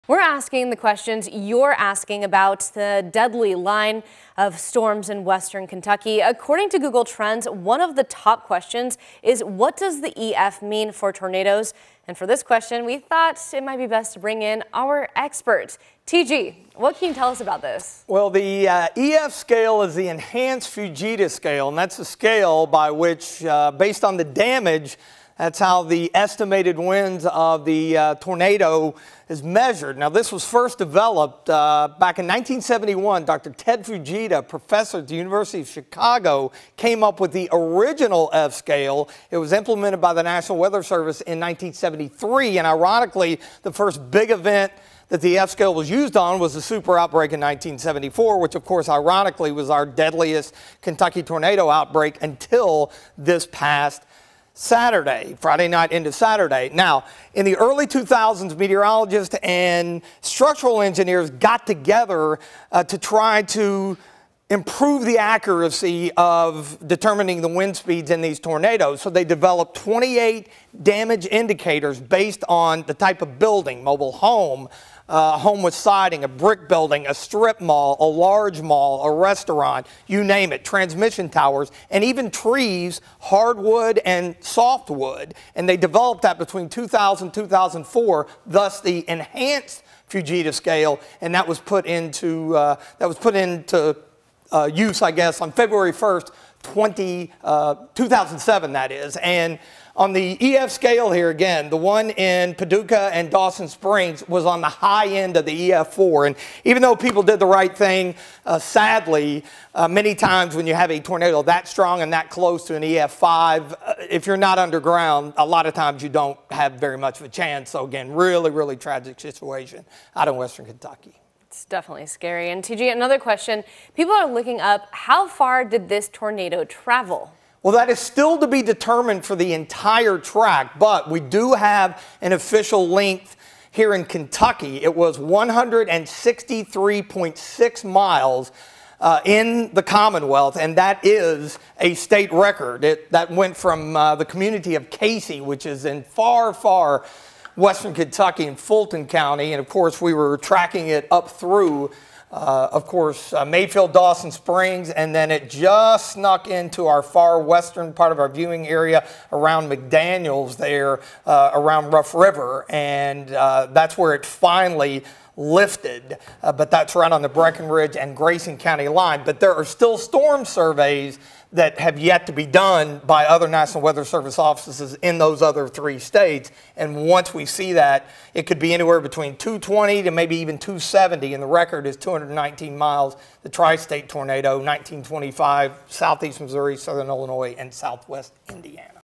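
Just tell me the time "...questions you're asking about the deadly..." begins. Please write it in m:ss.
0:00.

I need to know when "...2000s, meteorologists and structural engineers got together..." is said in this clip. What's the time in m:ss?
0:57.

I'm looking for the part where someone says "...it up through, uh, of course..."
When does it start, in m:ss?
2:30.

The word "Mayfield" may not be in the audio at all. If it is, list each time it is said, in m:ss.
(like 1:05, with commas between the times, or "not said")
2:33.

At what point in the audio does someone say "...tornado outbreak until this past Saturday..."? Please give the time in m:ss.
0:51.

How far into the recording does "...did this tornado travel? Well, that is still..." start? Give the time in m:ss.
2:05.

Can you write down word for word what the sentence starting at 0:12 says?
And for this question, we thought it might be best to bring in our expert.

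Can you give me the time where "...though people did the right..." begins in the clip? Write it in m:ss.
1:46.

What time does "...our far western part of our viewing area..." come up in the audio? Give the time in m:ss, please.
2:36.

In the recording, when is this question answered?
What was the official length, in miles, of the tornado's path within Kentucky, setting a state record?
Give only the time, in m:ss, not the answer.
2:15.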